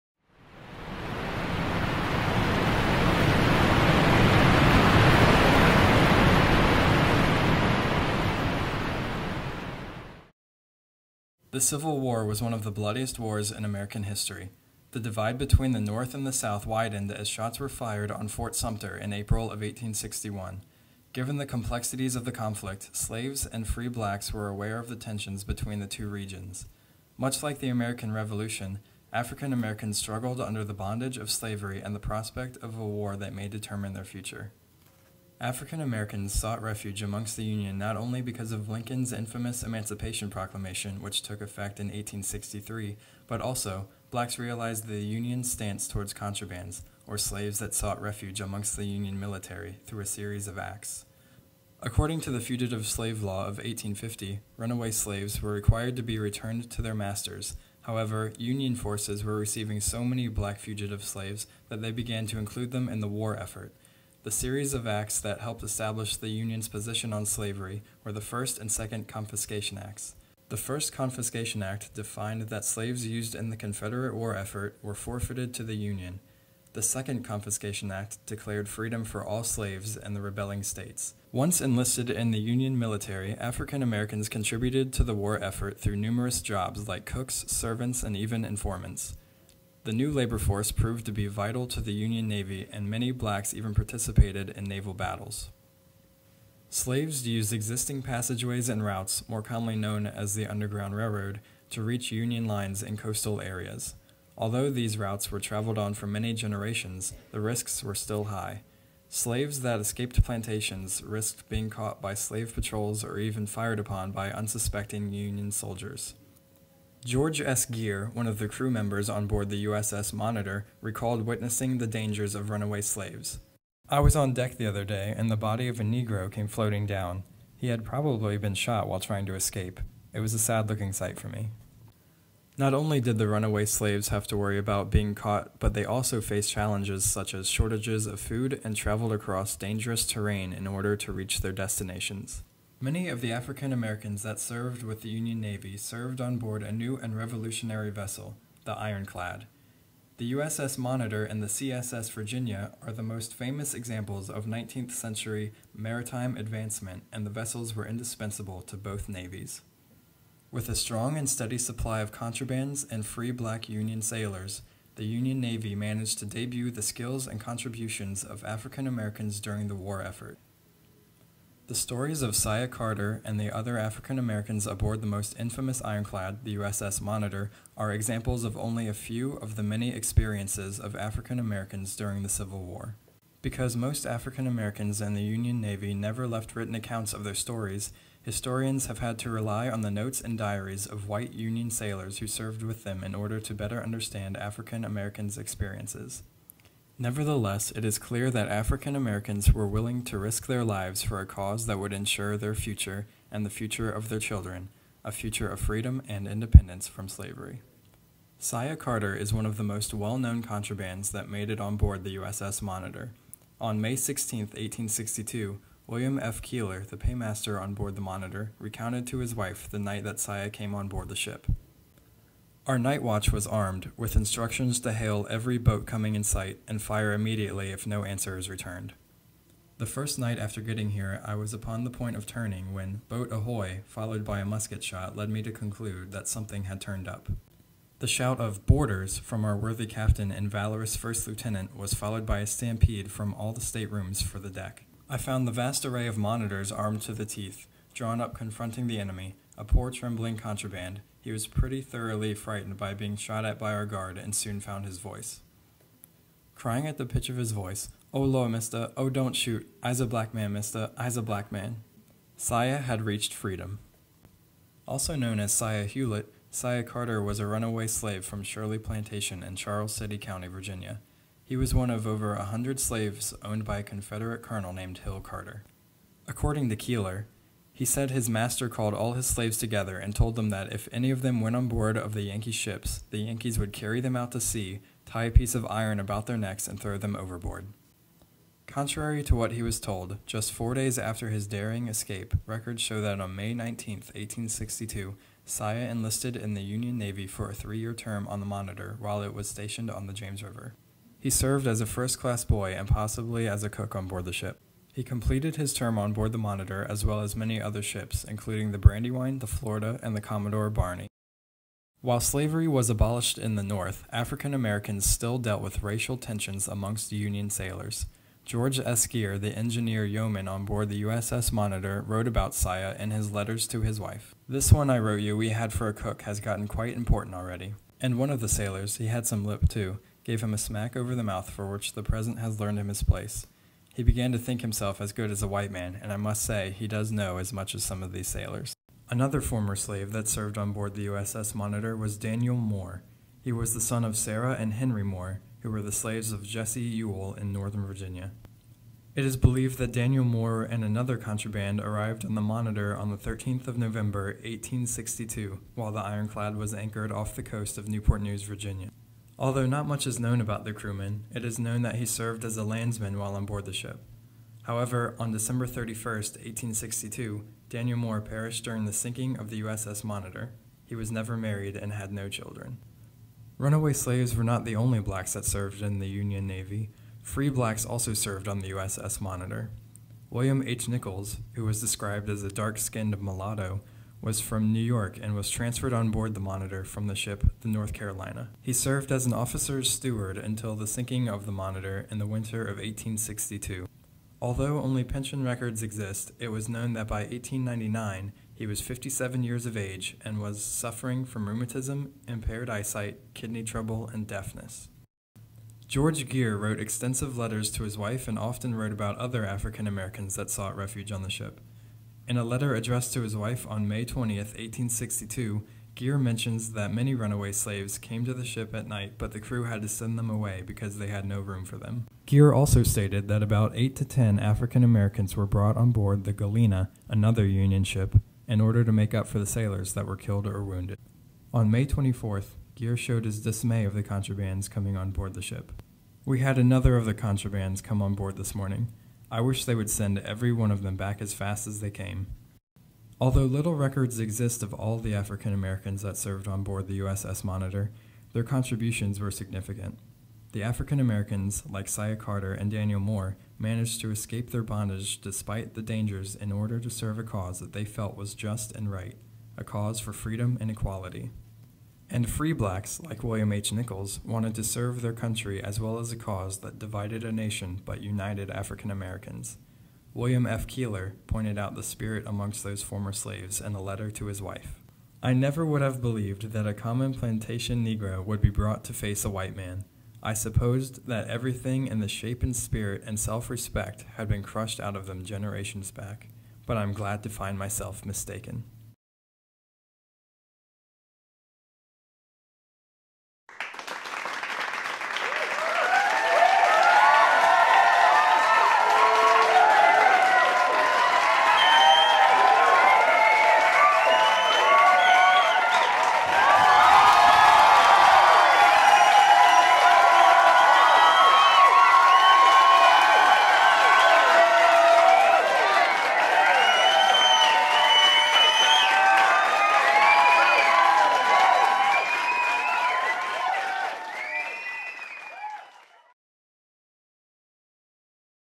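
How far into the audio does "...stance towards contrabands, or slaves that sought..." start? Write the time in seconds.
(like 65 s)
45 s.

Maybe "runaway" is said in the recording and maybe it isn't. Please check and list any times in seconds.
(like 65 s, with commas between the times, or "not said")
54 s, 122 s, 133 s, 267 s, 373 s, 417 s.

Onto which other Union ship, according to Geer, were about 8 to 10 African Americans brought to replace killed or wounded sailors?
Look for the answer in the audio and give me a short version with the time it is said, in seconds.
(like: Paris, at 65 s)
Galena, at 426 s.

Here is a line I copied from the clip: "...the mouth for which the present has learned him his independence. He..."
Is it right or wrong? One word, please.
wrong.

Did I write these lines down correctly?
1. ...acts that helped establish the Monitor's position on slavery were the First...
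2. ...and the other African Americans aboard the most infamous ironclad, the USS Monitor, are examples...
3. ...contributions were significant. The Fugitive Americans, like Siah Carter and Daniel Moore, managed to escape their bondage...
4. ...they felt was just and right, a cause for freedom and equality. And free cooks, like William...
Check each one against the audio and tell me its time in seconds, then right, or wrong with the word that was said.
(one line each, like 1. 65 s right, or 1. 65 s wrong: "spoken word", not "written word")
1. 64 s wrong: "Union", not "Monitor"
2. 173 s right
3. 448 s wrong: "African", not "Fugitive"
4. 457 s wrong: "blacks", not "cooks".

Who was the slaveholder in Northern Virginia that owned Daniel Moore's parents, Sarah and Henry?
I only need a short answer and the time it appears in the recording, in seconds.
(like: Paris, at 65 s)
Jesse Ewell, at 346 s.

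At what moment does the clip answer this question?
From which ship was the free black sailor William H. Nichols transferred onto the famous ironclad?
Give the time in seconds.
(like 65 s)
387 s.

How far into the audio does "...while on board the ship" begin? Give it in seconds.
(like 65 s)
363 s.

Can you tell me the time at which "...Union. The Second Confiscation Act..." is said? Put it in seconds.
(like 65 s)
75 s.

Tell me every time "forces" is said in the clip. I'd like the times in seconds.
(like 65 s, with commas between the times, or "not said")
58 s, 90 s.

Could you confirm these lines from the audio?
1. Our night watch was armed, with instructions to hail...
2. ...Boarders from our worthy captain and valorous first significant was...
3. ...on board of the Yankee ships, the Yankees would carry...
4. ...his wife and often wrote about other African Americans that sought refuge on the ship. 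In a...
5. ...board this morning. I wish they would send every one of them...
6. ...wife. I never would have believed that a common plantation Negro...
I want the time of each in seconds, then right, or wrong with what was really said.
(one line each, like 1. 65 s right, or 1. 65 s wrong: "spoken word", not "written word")
1. 222 s right
2. 238 s wrong: "lieutenant", not "significant"
3. 281 s right
4. 407 s right
5. 438 s right
6. 474 s right.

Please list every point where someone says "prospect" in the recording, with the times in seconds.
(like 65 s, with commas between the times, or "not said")
31 s.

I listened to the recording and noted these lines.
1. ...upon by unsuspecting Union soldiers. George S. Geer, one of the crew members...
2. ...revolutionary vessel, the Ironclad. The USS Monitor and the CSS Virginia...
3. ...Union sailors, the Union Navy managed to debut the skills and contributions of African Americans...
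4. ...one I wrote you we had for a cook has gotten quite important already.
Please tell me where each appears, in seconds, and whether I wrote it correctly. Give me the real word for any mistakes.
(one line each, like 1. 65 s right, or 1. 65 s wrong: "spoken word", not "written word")
1. 113 s right
2. 147 s right
3. 163 s right
4. 324 s right.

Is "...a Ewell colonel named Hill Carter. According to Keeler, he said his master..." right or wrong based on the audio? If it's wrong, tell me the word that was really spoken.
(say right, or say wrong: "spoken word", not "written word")
wrong: "Confederate", not "Ewell".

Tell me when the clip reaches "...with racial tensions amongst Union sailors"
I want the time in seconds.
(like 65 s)
315 s.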